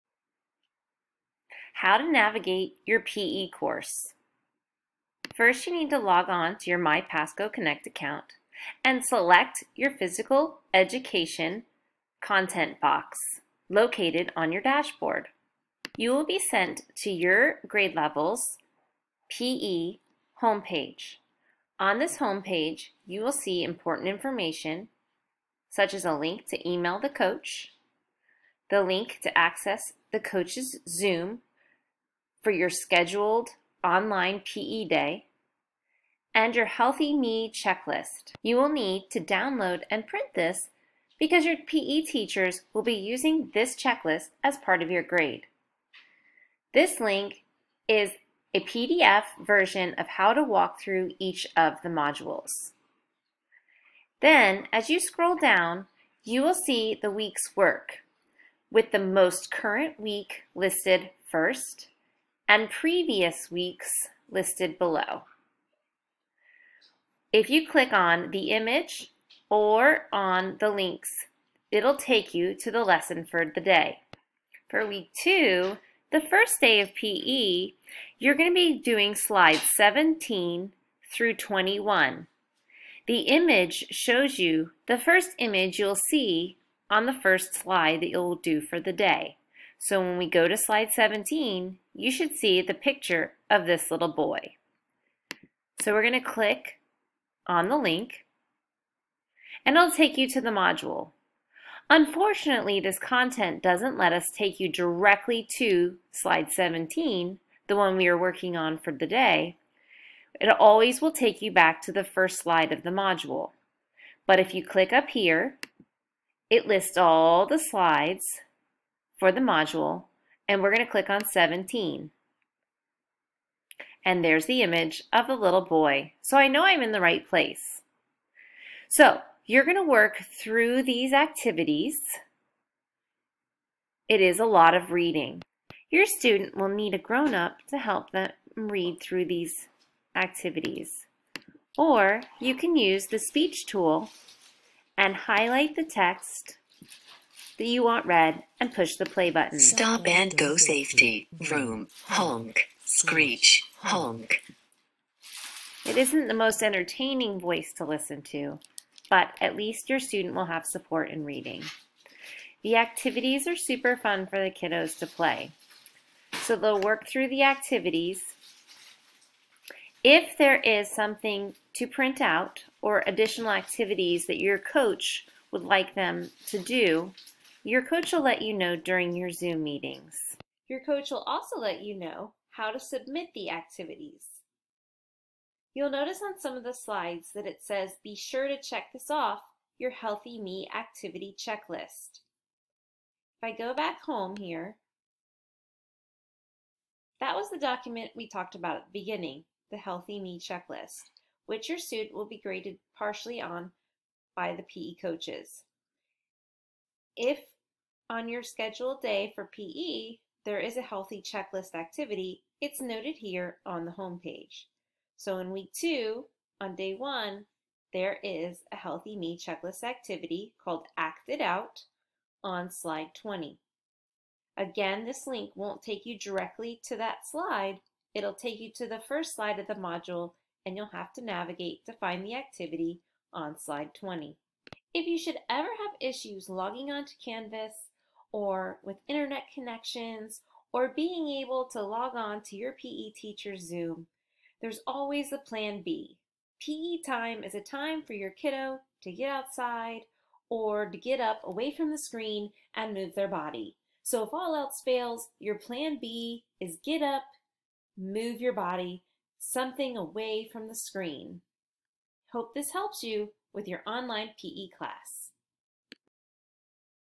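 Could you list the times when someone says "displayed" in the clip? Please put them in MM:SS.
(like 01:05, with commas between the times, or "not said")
not said.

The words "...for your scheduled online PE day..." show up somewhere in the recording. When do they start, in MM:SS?
00:32.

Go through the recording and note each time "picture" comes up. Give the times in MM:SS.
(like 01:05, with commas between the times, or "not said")
01:32.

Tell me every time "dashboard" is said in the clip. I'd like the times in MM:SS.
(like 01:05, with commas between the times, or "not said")
00:14.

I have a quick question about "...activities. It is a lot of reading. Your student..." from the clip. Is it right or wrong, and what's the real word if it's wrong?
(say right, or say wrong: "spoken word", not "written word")
right.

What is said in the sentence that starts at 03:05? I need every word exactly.
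You'll notice on some of the slides that it says, be sure to check this off your Healthy Me activity checklist.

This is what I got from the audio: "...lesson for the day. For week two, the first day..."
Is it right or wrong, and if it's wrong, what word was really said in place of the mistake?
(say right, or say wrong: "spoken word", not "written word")
right.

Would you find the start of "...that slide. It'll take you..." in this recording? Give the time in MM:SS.
03:46.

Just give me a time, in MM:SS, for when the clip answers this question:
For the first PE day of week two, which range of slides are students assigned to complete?
01:19.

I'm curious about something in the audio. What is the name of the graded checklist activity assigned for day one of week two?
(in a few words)
Act It Out.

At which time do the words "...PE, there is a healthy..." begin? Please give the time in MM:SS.
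03:29.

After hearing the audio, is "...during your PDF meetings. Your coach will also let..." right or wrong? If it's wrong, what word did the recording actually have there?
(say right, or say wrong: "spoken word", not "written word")
wrong: "Zoom", not "PDF".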